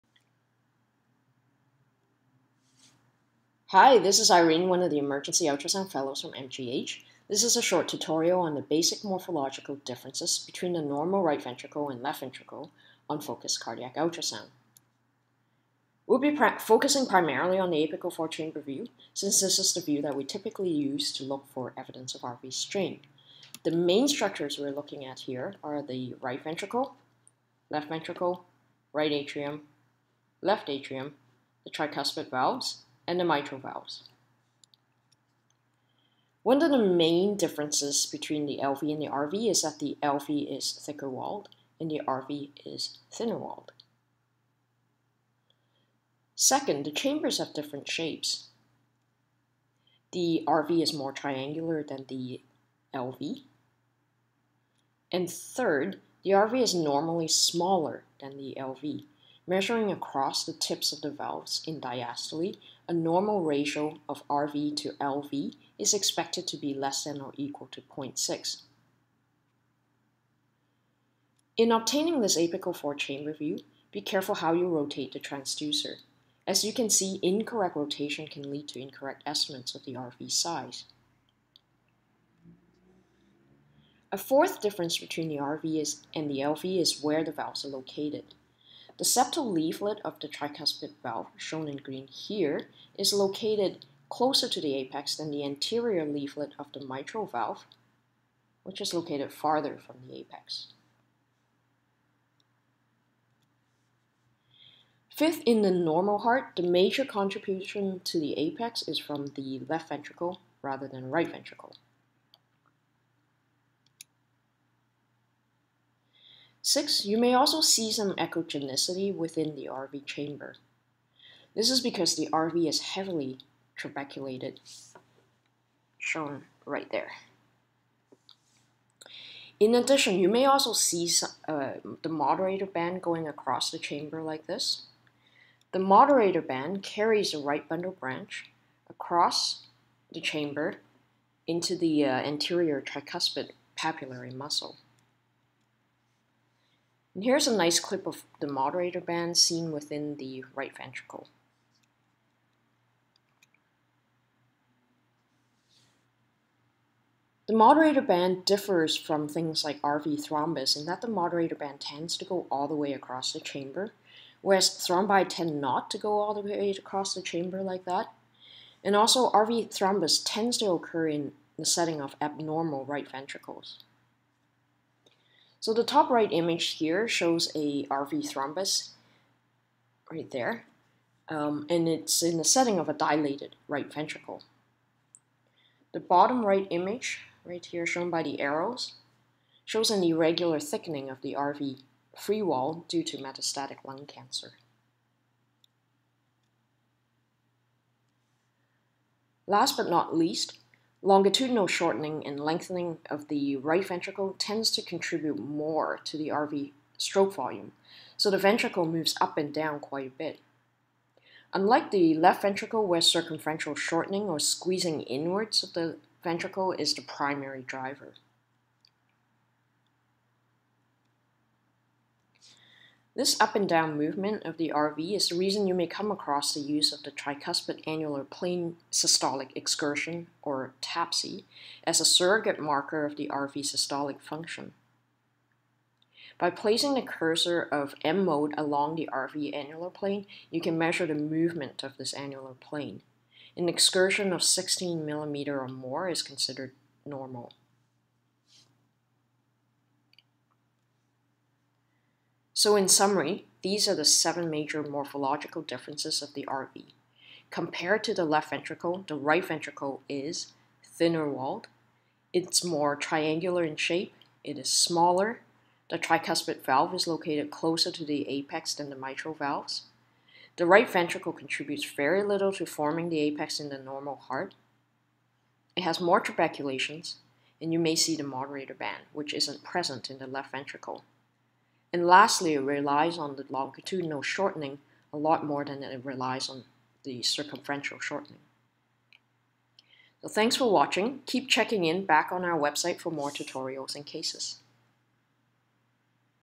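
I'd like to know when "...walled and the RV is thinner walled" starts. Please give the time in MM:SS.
00:41.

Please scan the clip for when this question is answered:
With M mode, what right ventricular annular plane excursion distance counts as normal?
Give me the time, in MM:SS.
04:04.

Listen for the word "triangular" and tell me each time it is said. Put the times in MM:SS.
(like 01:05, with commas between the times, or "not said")
00:51, 04:22.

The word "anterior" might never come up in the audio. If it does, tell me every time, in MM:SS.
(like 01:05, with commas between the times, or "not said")
01:35, 02:22.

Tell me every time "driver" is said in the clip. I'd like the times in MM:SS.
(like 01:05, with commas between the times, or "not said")
03:37.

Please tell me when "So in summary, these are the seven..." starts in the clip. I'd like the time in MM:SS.
04:12.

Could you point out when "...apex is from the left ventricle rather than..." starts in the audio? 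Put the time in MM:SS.
01:48.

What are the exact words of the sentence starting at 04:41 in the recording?
And lastly, it relies on the longitudinal shortening a lot more than it relies on the circumferential shortening.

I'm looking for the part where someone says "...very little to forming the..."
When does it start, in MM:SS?
04:31.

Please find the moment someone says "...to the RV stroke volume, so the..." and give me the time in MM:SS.
03:26.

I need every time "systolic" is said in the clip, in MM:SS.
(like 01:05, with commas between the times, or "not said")
03:48, 03:53.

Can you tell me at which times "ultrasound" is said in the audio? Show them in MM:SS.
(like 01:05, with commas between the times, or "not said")
00:05, 00:13.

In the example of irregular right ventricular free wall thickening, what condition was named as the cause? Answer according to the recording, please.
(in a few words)
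metastatic lung cancer.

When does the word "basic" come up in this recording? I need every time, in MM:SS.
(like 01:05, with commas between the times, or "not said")
00:08.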